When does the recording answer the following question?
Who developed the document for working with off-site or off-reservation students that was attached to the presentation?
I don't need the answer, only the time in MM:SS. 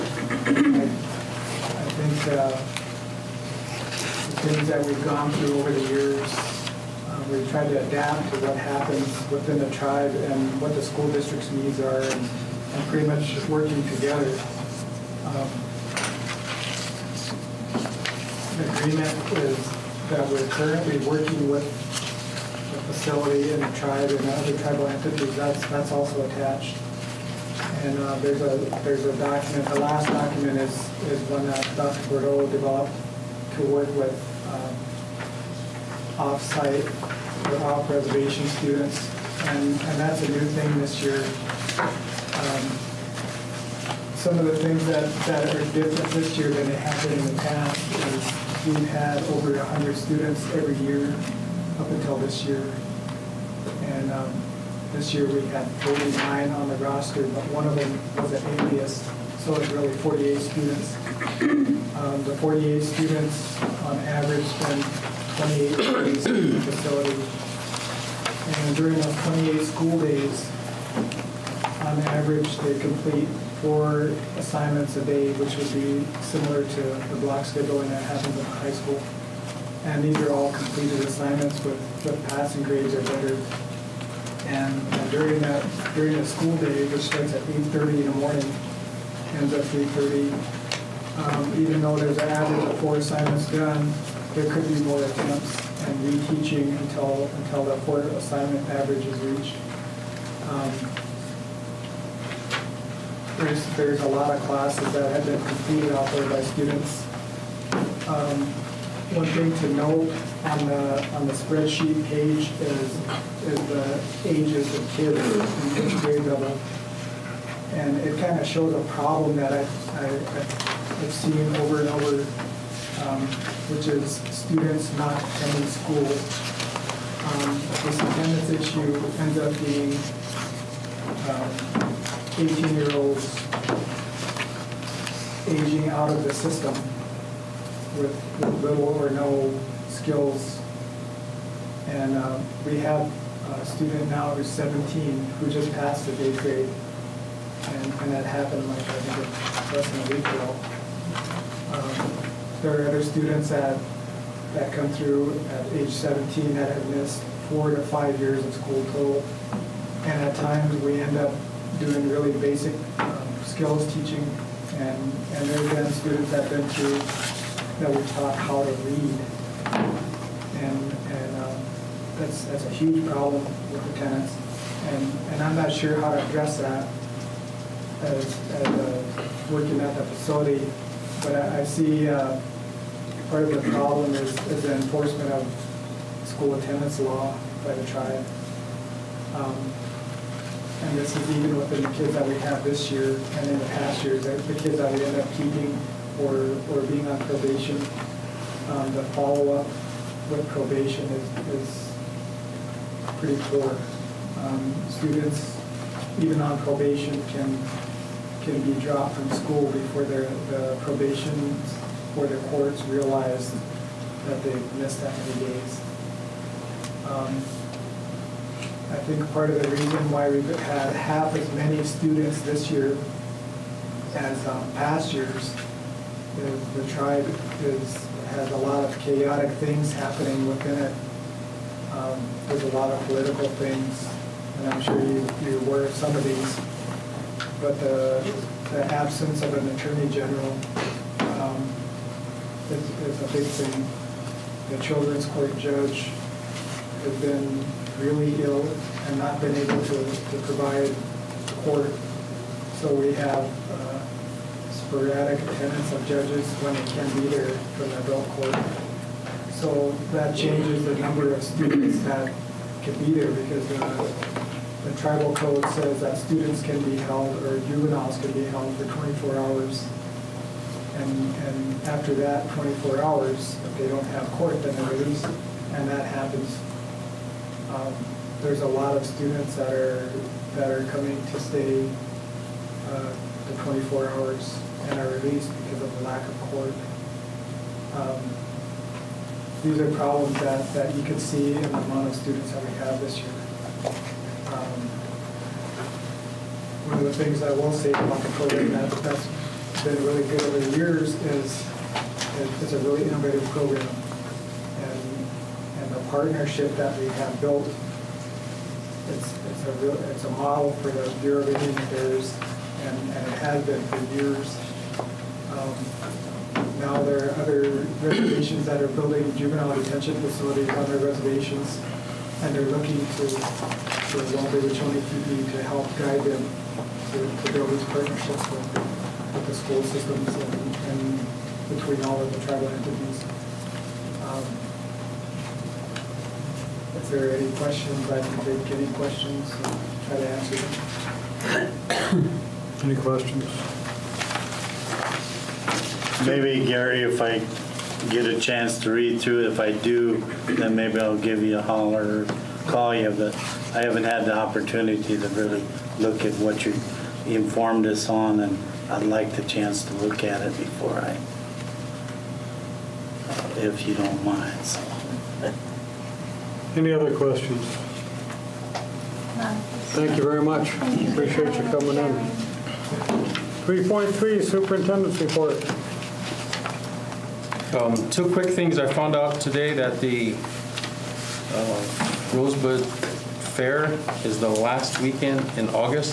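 00:31.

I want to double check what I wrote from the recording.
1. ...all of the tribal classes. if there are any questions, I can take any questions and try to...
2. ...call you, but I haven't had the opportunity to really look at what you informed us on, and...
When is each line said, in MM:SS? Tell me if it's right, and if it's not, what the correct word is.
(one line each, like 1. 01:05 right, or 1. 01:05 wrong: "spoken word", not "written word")
1. 05:32 wrong: "entities", not "classes"
2. 05:52 right.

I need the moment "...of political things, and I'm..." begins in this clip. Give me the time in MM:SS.
03:52.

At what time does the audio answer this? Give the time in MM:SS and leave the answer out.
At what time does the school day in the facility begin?
01:27.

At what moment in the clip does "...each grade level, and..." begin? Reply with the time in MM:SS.
01:55.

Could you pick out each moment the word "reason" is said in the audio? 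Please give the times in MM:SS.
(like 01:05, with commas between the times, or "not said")
03:39.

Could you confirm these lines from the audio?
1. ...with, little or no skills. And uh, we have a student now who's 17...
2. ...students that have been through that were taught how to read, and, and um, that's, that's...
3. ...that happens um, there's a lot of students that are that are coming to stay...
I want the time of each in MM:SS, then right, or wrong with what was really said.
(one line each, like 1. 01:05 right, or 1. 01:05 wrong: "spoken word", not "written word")
1. 02:17 right
2. 02:45 right
3. 04:35 right.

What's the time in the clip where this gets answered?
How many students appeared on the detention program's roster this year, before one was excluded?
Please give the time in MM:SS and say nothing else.
00:55.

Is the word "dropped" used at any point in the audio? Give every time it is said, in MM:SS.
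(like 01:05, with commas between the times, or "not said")
03:28.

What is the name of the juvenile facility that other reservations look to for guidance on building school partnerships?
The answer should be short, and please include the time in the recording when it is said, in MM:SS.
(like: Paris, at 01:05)
Wanbli Wiconi Tipi, at 05:24.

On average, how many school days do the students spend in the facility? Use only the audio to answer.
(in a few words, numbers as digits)
28.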